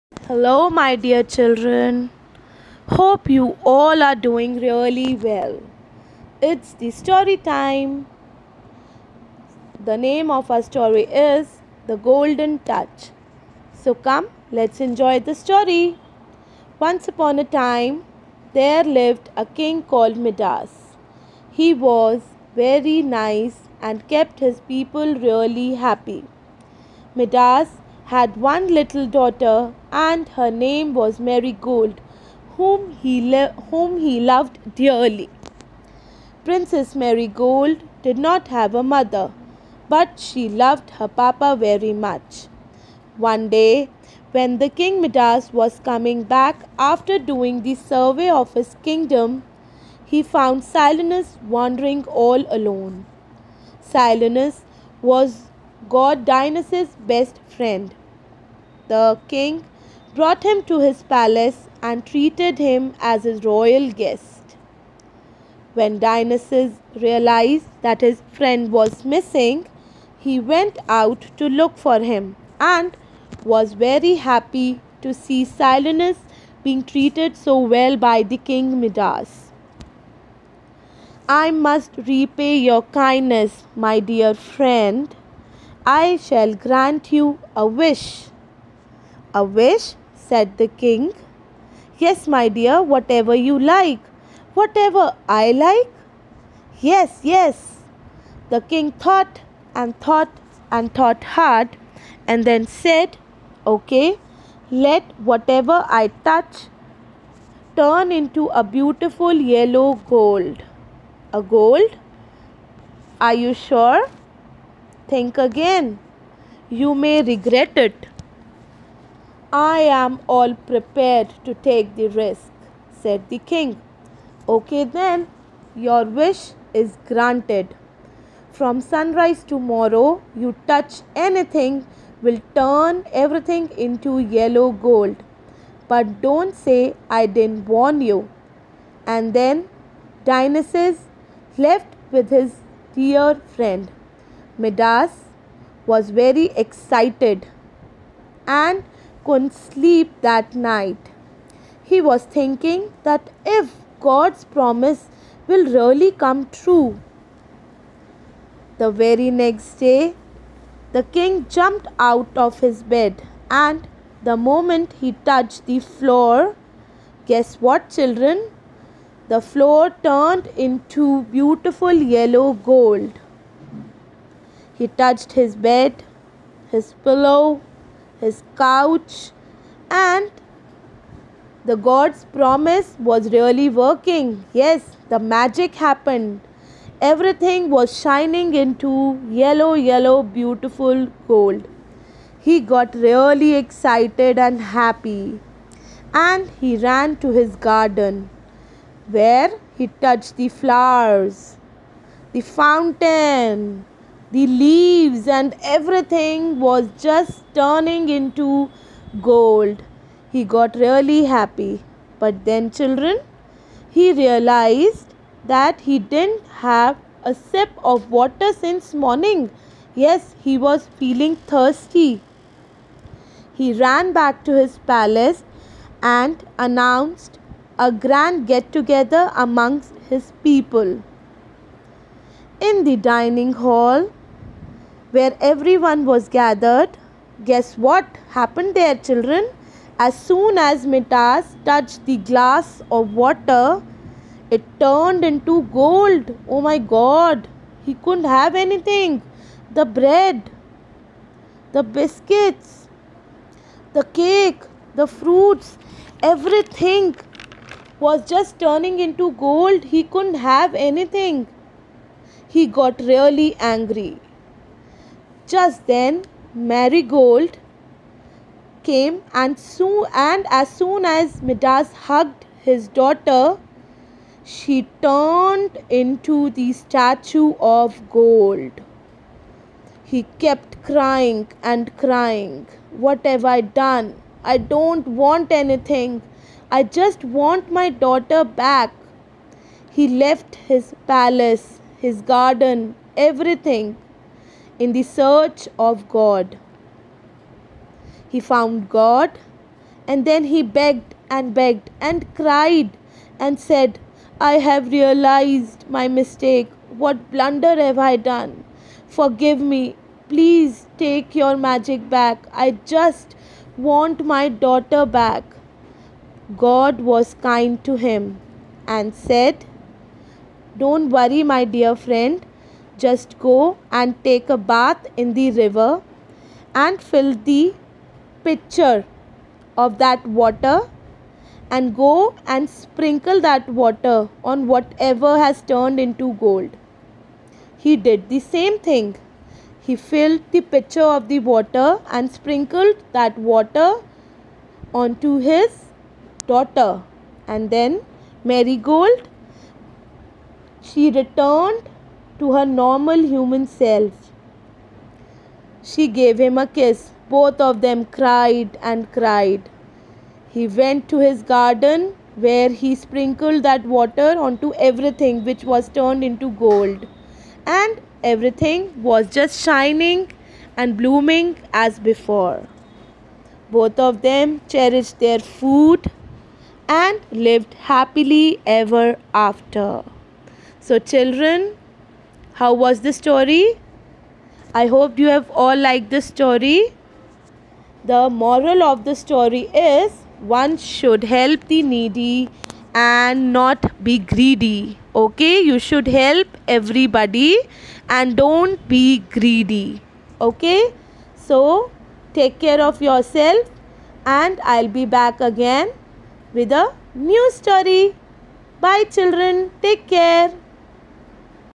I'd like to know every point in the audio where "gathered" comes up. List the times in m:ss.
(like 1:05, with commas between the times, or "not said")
3:56.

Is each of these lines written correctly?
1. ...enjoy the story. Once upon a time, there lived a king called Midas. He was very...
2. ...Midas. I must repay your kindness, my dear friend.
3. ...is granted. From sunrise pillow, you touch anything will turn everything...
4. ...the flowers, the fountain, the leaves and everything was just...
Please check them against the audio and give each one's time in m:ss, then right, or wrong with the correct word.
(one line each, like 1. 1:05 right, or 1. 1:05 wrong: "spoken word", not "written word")
1. 0:14 right
2. 1:18 right
3. 2:06 wrong: "tomorrow", not "pillow"
4. 3:20 right.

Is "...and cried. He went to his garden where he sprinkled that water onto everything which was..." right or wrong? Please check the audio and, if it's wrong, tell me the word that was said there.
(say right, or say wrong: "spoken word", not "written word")
right.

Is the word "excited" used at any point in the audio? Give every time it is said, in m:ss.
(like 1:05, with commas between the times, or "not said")
2:26, 3:13.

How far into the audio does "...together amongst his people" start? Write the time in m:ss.
3:48.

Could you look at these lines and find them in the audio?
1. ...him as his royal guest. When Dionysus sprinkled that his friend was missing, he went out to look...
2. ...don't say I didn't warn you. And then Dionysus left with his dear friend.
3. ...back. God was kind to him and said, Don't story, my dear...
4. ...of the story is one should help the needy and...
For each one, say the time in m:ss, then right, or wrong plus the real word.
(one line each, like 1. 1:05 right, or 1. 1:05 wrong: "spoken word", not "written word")
1. 1:02 wrong: "realized", not "sprinkled"
2. 2:16 right
3. 5:15 wrong: "worry", not "story"
4. 6:28 right.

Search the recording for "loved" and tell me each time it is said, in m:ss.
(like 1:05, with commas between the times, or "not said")
0:34, 0:40.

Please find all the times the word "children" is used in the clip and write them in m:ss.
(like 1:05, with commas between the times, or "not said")
0:01, 2:47, 3:32, 3:58, 6:20, 6:49.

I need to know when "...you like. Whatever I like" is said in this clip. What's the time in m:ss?
1:33.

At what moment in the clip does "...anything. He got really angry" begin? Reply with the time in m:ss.
4:20.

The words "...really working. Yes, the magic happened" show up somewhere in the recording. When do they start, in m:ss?
3:03.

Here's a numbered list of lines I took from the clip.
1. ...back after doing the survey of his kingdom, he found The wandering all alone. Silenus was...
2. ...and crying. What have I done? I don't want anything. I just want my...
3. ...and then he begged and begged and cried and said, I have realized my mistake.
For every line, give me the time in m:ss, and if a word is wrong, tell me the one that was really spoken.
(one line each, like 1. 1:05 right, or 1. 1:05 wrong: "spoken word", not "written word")
1. 0:46 wrong: "Silenus", not "The"
2. 4:41 right
3. 5:00 right.